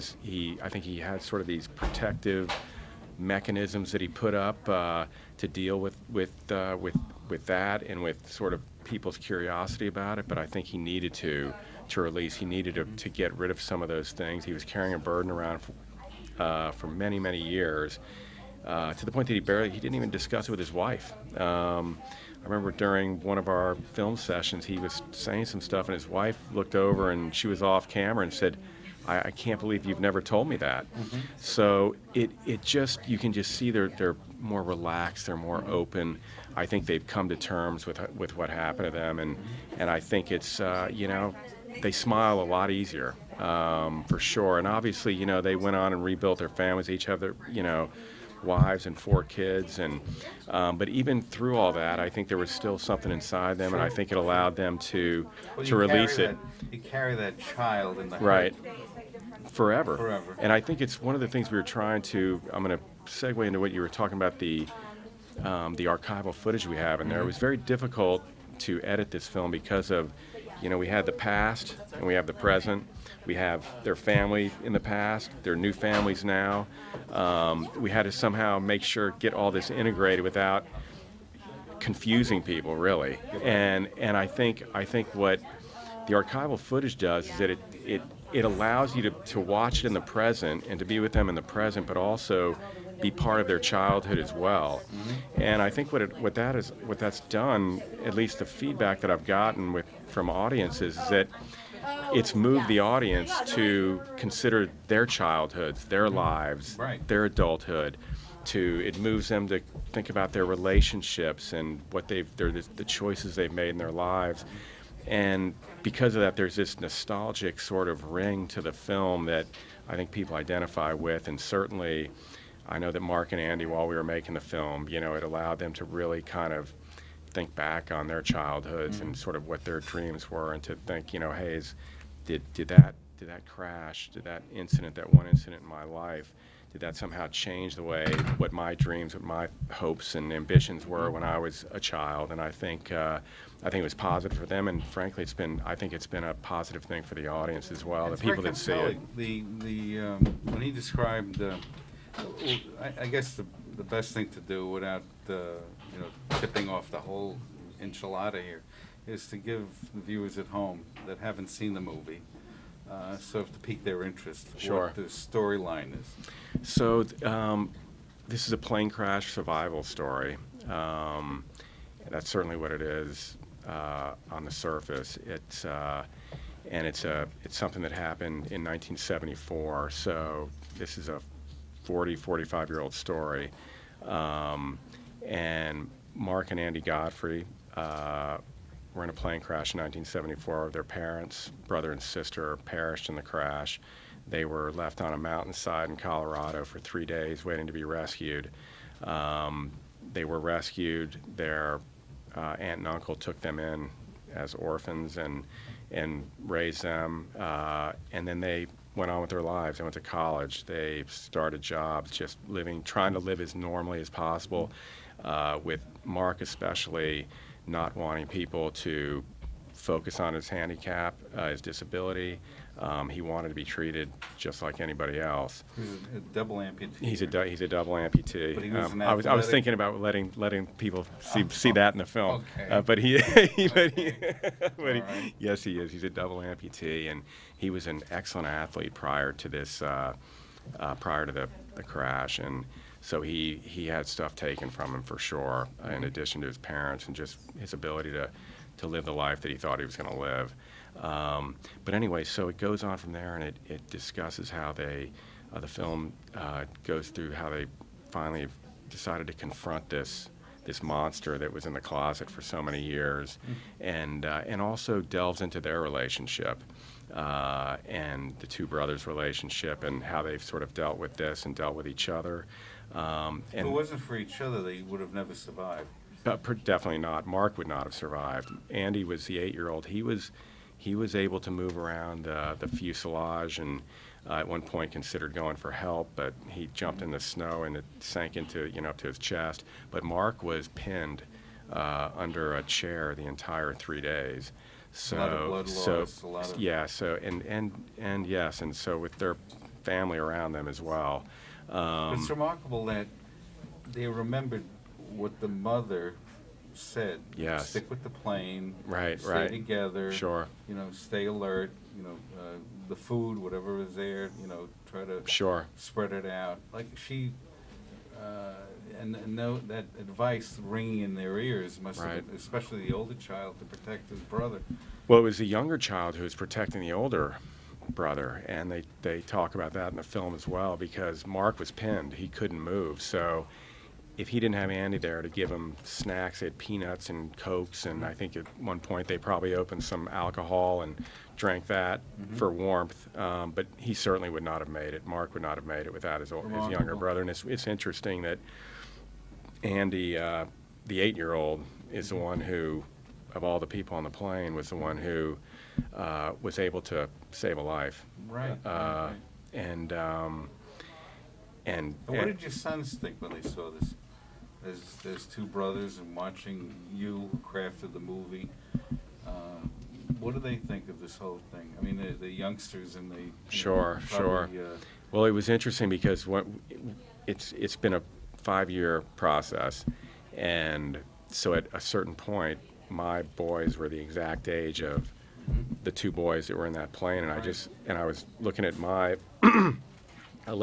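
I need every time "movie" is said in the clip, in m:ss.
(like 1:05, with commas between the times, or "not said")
2:41, 6:07.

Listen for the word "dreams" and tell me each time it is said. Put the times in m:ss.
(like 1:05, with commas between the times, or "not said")
2:09, 2:18.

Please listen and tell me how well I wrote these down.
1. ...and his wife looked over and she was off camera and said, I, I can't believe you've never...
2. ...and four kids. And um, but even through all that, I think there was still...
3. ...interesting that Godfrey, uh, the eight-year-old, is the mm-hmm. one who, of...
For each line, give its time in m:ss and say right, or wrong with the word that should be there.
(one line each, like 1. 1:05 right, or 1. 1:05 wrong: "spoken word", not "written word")
1. 0:25 right
2. 0:48 right
3. 5:47 wrong: "Andy", not "Godfrey".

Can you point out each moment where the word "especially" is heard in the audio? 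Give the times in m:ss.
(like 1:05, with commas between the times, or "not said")
3:36, 5:22.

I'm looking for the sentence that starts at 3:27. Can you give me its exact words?
Uh, and then they went on with their lives.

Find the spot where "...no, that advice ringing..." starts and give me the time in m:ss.
5:19.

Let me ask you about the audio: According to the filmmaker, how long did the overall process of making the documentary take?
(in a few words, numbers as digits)
5 years.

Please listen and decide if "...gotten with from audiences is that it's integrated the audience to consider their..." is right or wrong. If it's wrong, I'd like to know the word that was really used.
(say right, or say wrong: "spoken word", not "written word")
wrong: "moved", not "integrated".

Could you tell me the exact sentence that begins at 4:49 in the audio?
But Mark was pinned uh, under a chair the entire three days.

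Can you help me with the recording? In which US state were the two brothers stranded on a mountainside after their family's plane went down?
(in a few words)
Colorado.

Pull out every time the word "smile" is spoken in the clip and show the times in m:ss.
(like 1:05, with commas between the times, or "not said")
0:41.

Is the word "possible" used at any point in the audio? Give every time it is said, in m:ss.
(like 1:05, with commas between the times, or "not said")
3:34.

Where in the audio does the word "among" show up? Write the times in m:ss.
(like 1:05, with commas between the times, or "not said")
not said.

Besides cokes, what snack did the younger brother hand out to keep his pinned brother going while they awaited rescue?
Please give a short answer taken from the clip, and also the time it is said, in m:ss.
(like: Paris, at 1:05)
Peanuts, at 5:36.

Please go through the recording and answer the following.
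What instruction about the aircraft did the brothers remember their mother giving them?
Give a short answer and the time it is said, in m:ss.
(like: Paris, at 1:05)
Stick with the plane, at 5:07.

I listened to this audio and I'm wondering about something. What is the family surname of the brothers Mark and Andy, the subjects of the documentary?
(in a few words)
Godfrey.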